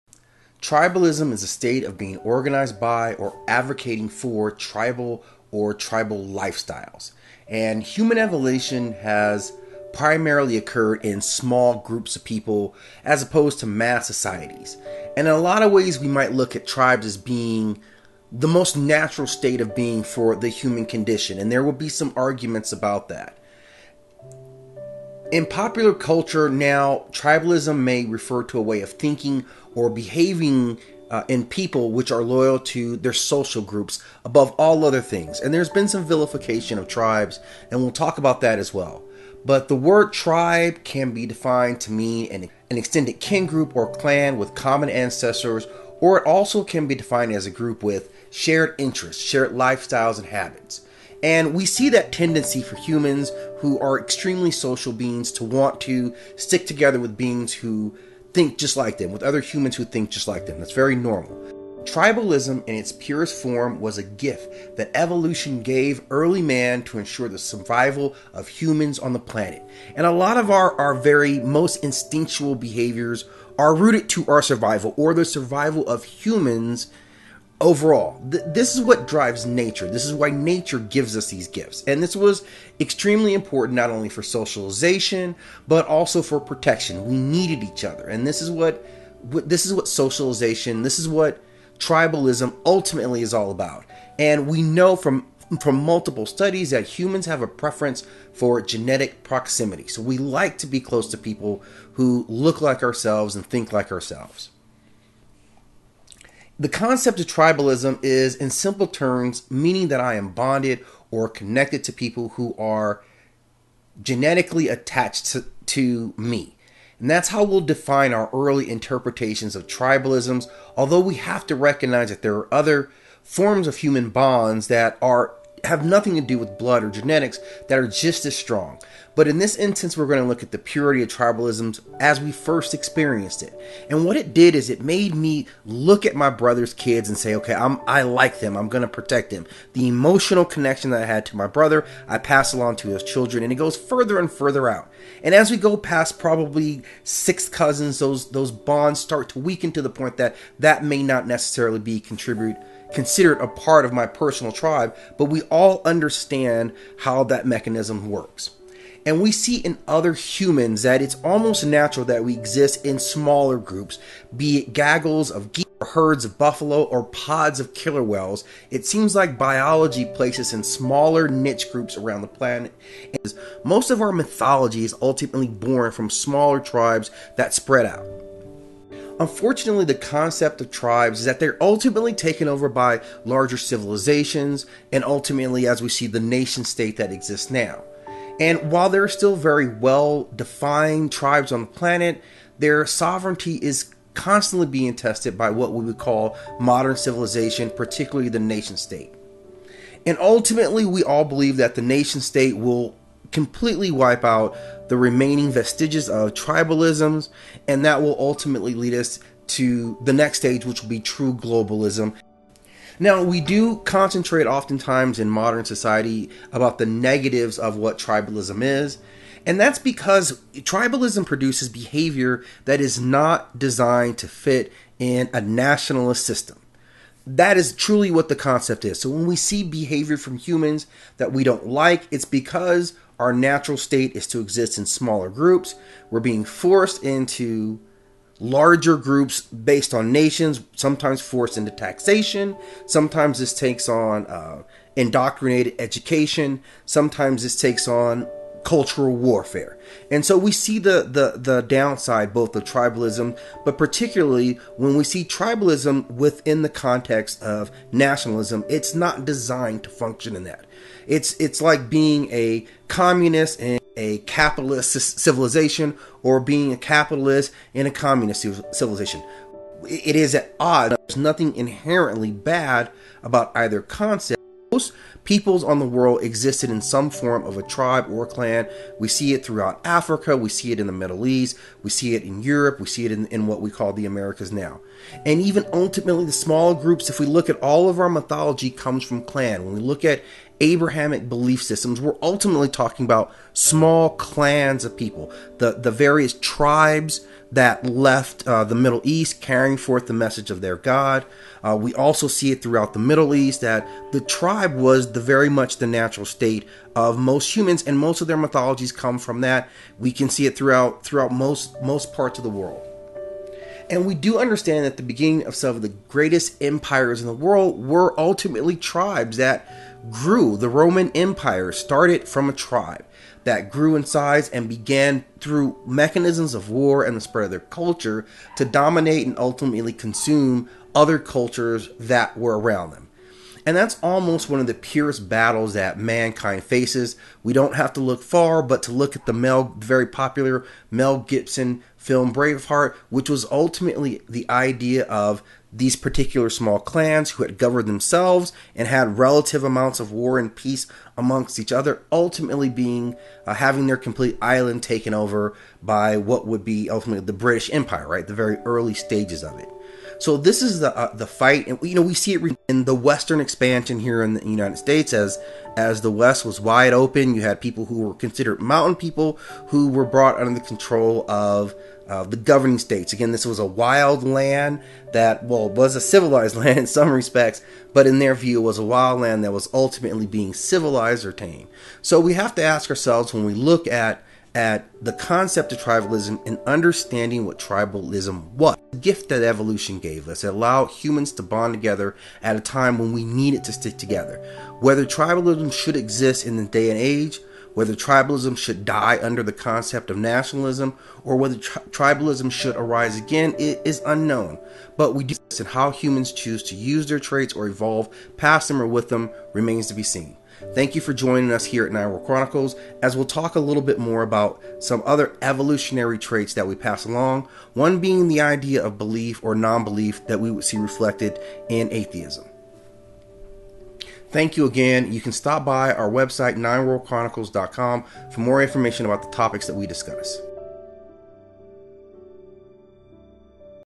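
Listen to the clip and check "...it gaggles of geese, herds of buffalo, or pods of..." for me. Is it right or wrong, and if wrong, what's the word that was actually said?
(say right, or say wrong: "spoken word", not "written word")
right.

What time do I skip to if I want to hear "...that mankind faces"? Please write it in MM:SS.
05:35.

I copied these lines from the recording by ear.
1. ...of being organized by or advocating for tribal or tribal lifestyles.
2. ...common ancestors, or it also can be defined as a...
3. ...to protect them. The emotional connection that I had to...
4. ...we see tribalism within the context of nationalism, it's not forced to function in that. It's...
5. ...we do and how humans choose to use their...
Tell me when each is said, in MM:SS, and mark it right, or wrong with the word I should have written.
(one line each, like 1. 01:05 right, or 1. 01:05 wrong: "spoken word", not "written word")
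1. 00:01 right
2. 00:44 right
3. 02:18 right
4. 04:14 wrong: "designed", not "forced"
5. 06:45 right.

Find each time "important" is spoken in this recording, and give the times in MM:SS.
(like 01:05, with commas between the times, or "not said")
01:23.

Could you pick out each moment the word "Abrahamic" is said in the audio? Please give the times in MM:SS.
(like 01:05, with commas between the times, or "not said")
04:50.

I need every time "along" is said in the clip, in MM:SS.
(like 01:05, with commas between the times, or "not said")
02:22, 06:57.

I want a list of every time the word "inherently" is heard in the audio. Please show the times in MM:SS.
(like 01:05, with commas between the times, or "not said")
04:31.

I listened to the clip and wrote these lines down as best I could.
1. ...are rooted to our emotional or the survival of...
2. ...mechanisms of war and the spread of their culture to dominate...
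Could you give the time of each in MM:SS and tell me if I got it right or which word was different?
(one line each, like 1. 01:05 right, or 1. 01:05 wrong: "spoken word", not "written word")
1. 01:13 wrong: "survival", not "emotional"
2. 05:25 right.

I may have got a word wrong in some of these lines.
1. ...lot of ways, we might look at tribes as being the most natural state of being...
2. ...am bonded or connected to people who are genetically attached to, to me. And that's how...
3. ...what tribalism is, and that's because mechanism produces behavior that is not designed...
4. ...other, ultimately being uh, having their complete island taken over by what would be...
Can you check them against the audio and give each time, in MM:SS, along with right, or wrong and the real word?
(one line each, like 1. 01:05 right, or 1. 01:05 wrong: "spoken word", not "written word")
1. 00:15 right
2. 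01:50 right
3. 03:37 wrong: "tribalism", not "mechanism"
4. 05:51 right.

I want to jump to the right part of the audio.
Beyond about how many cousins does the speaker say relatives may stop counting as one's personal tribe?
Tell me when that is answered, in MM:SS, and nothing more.
02:27.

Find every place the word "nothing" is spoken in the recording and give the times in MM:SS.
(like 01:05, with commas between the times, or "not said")
02:05, 04:31.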